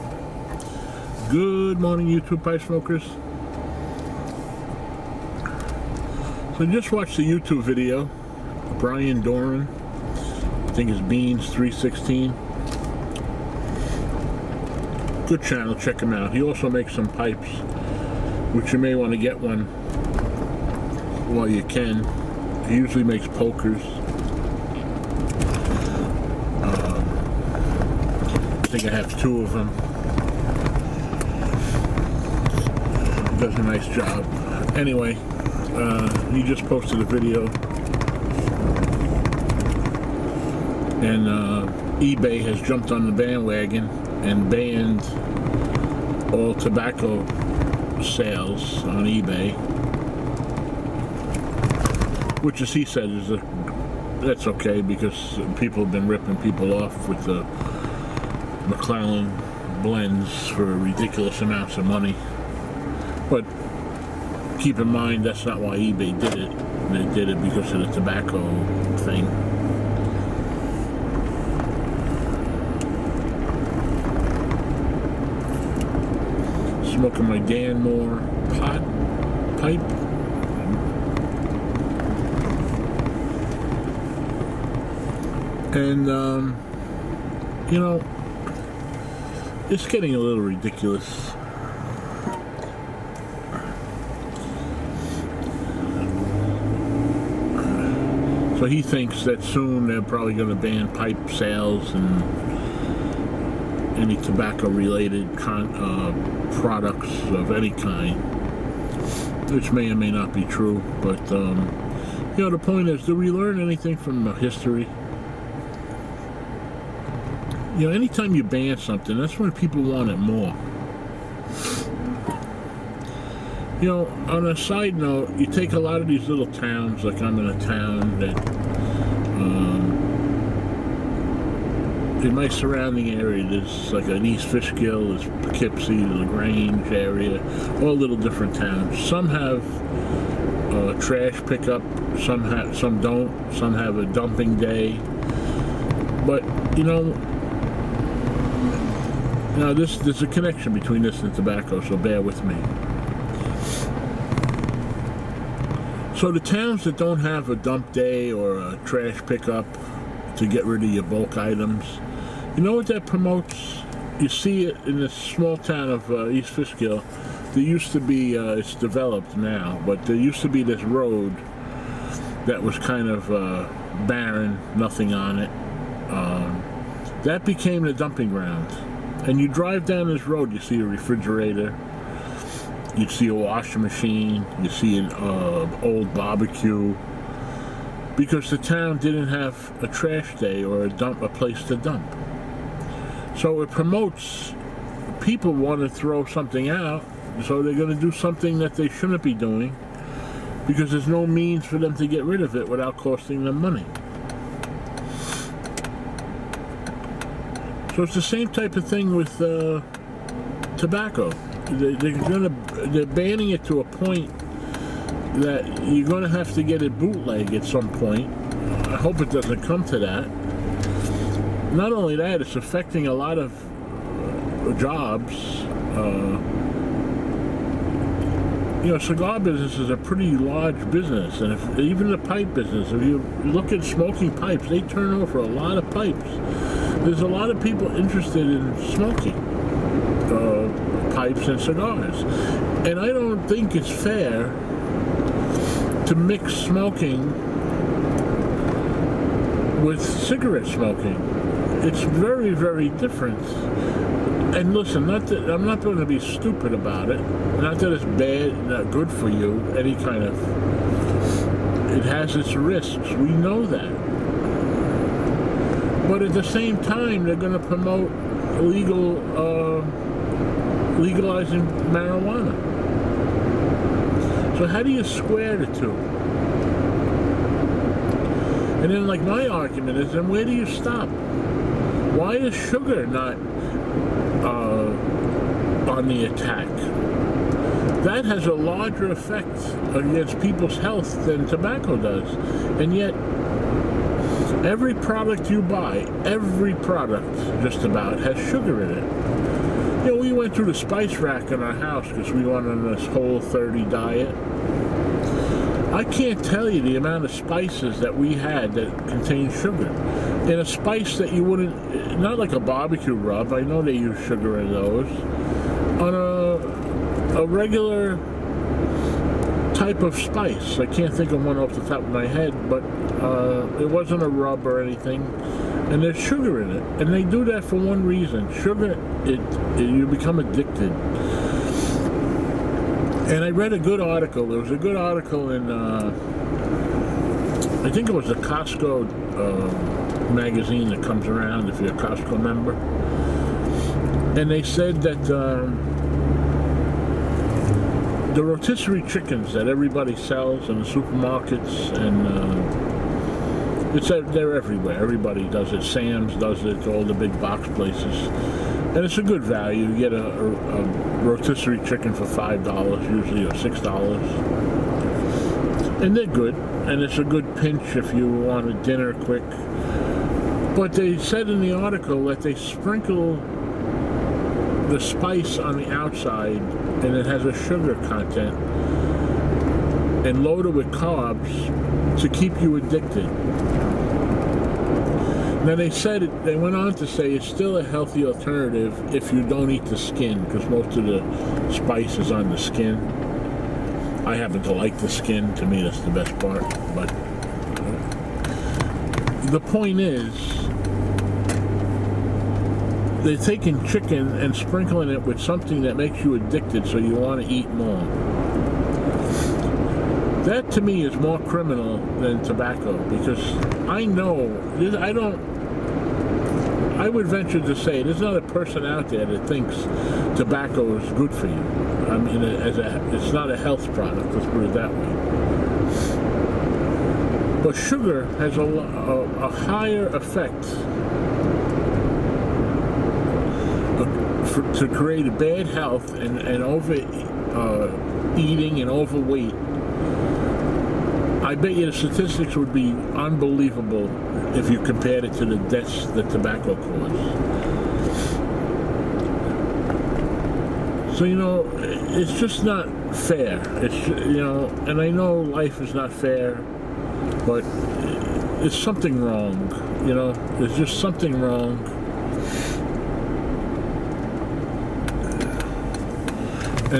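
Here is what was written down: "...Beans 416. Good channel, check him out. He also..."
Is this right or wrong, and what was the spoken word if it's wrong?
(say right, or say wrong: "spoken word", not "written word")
wrong: "316", not "416".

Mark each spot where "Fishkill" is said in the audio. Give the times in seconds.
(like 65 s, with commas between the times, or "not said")
134 s, 166 s.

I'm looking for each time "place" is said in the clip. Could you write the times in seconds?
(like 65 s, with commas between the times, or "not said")
191 s, 357 s.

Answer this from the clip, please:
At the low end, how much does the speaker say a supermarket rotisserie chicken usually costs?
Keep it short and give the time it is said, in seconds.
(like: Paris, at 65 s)
$5, at 362 s.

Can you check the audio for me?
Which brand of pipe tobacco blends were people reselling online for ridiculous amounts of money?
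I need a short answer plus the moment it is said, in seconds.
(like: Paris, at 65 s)
McClelland, at 58 s.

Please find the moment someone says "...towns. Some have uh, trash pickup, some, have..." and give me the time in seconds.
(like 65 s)
138 s.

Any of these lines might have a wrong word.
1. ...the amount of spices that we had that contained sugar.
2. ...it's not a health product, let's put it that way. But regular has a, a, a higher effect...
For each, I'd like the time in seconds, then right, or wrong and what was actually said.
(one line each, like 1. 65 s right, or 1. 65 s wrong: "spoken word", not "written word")
1. 306 s right
2. 423 s wrong: "sugar", not "regular".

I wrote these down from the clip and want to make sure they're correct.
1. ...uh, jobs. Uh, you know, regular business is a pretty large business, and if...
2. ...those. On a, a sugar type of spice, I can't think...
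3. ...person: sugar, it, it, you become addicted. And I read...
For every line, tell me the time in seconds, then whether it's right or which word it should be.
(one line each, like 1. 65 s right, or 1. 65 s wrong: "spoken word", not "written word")
1. 224 s wrong: "cigar", not "regular"
2. 314 s wrong: "regular", not "sugar"
3. 328 s wrong: "reason", not "person".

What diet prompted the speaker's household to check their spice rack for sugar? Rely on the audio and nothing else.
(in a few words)
Whole 30.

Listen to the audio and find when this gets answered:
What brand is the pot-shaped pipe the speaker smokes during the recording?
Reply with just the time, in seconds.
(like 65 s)
77 s.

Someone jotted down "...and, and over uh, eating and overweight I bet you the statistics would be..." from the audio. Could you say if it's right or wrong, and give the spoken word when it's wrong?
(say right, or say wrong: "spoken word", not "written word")
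right.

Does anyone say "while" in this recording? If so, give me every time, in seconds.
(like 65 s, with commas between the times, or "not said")
21 s.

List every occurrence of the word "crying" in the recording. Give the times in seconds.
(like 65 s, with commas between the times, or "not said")
not said.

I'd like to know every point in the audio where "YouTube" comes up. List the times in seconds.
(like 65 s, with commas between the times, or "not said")
2 s, 7 s.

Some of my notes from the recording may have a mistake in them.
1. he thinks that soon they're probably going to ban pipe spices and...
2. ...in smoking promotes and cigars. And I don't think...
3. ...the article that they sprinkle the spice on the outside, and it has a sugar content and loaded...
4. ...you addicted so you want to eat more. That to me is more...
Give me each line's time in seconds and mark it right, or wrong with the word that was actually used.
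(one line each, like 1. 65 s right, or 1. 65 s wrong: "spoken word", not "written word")
1. 98 s wrong: "sales", not "spices"
2. 238 s wrong: "pipes", not "promotes"
3. 371 s right
4. 406 s right.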